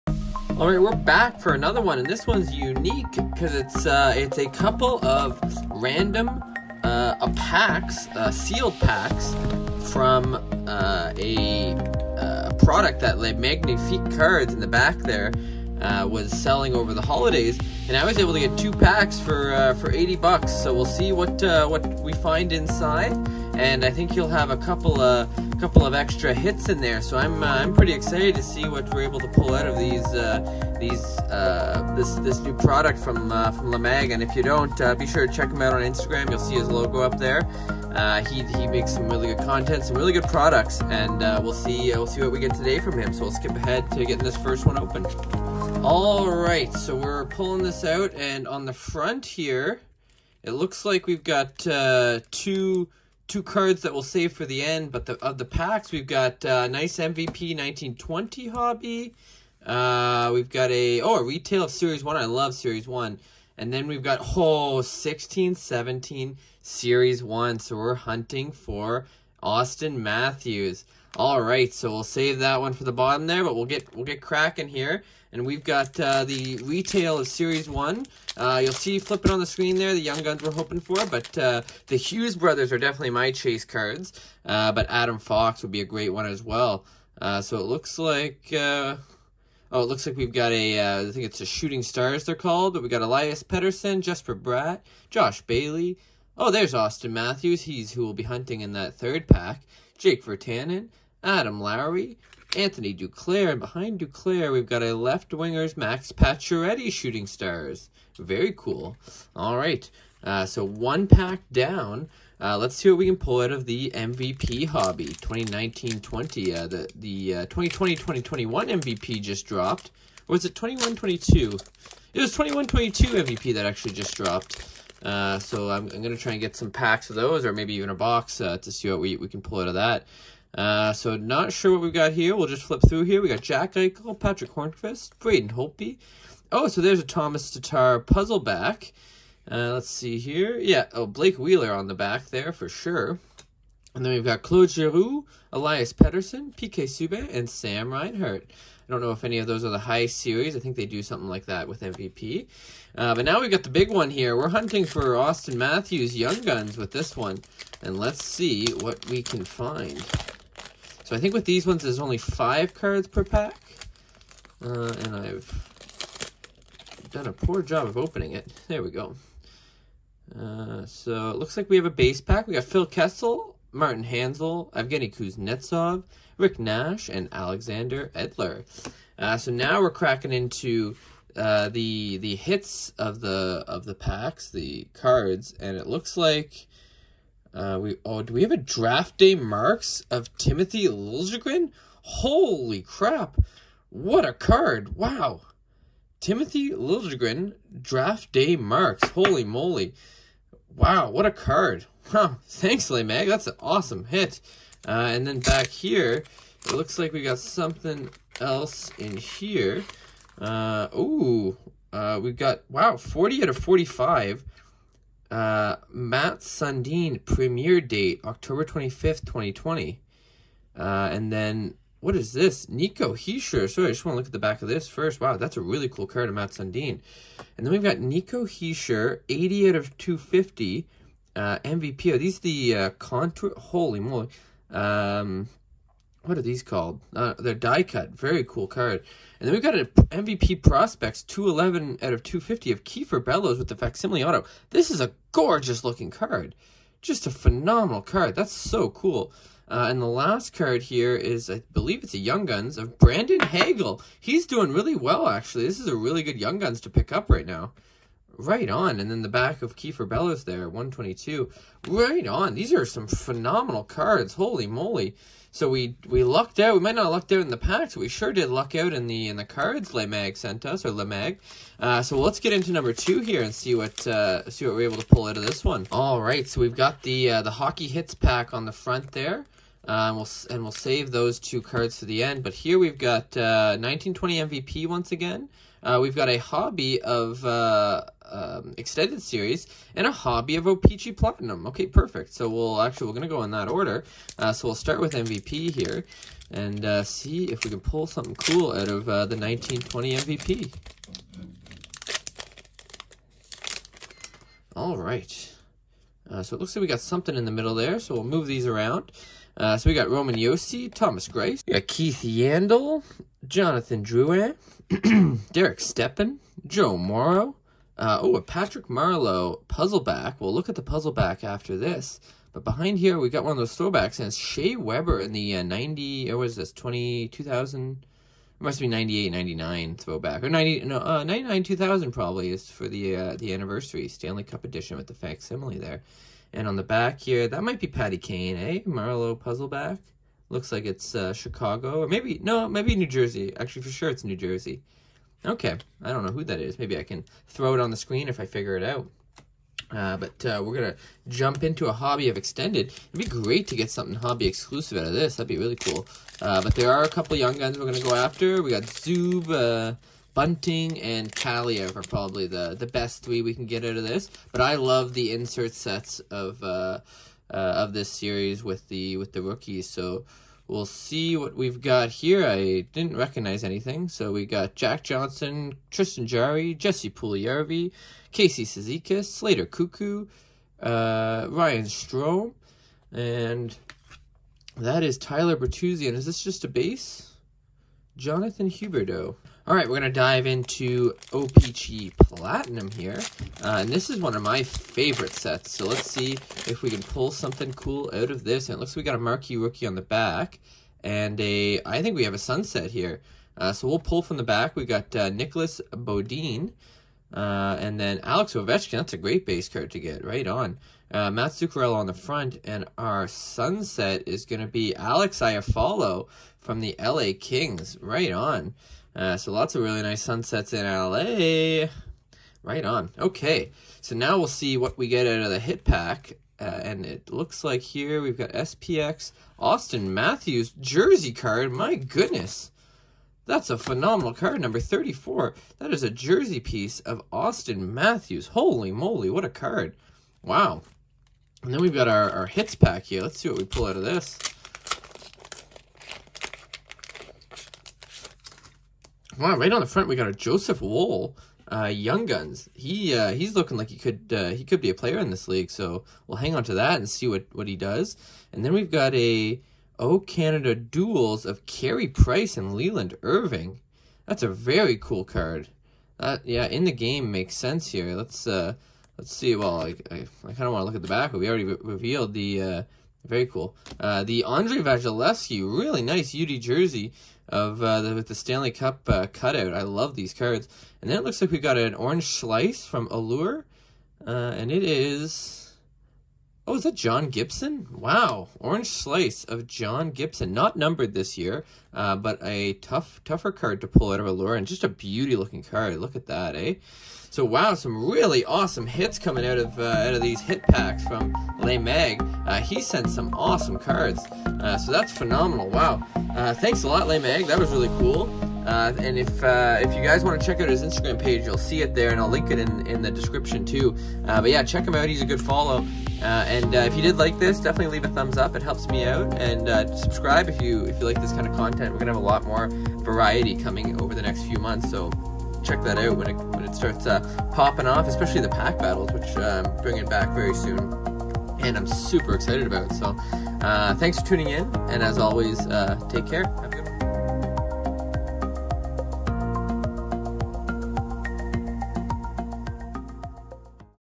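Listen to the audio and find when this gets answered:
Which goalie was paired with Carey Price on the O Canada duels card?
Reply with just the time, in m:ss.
7:42.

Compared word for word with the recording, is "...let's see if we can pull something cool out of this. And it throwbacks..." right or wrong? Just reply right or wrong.
wrong.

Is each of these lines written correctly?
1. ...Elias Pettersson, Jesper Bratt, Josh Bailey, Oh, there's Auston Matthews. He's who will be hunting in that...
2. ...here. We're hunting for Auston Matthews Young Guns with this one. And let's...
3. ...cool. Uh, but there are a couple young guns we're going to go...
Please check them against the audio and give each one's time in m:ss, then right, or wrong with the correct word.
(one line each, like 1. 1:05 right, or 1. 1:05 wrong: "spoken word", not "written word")
1. 1:33 right
2. 2:34 right
3. 5:55 right.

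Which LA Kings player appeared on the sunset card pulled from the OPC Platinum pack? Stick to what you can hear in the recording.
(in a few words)
Alex Iafallo.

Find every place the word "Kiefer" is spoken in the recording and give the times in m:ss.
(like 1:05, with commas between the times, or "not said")
4:02, 4:19.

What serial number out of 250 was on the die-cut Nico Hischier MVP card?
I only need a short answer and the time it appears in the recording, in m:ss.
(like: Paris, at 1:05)
80, at 3:49.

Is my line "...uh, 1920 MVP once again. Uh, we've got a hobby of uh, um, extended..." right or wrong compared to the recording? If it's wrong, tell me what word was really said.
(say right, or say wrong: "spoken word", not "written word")
right.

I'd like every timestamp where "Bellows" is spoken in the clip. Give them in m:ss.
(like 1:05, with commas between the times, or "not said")
4:03, 4:20.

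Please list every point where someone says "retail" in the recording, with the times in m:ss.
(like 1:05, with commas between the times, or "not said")
1:01, 1:16.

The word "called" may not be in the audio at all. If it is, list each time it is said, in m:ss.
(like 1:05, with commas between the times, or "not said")
1:32, 3:56.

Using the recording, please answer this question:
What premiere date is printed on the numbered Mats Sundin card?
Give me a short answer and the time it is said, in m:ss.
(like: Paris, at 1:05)
October 25th, 2020, at 3:38.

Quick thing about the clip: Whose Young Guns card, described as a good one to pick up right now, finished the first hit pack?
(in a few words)
Brandon Hagel.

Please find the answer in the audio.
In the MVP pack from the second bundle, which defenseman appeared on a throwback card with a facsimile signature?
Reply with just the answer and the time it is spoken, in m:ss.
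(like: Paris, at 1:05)
Shea Weber, at 5:24.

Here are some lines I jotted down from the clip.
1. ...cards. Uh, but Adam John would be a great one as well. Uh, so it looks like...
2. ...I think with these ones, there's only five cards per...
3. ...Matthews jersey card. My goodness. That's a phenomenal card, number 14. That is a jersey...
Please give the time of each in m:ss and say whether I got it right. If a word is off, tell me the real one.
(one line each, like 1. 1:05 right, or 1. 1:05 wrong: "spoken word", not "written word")
1. 1:23 wrong: "Fox", not "John"
2. 2:41 right
3. 7:10 wrong: "34", not "14".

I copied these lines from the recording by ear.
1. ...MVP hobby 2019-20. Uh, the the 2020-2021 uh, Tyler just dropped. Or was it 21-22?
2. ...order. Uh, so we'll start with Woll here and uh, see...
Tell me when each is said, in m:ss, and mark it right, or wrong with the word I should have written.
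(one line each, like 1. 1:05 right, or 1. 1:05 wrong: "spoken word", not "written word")
1. 1:53 wrong: "MVP", not "Tyler"
2. 4:53 wrong: "MVP", not "Woll".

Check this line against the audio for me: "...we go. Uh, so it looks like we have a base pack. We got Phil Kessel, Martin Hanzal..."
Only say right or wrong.
right.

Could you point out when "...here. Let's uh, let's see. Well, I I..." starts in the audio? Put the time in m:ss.
7:47.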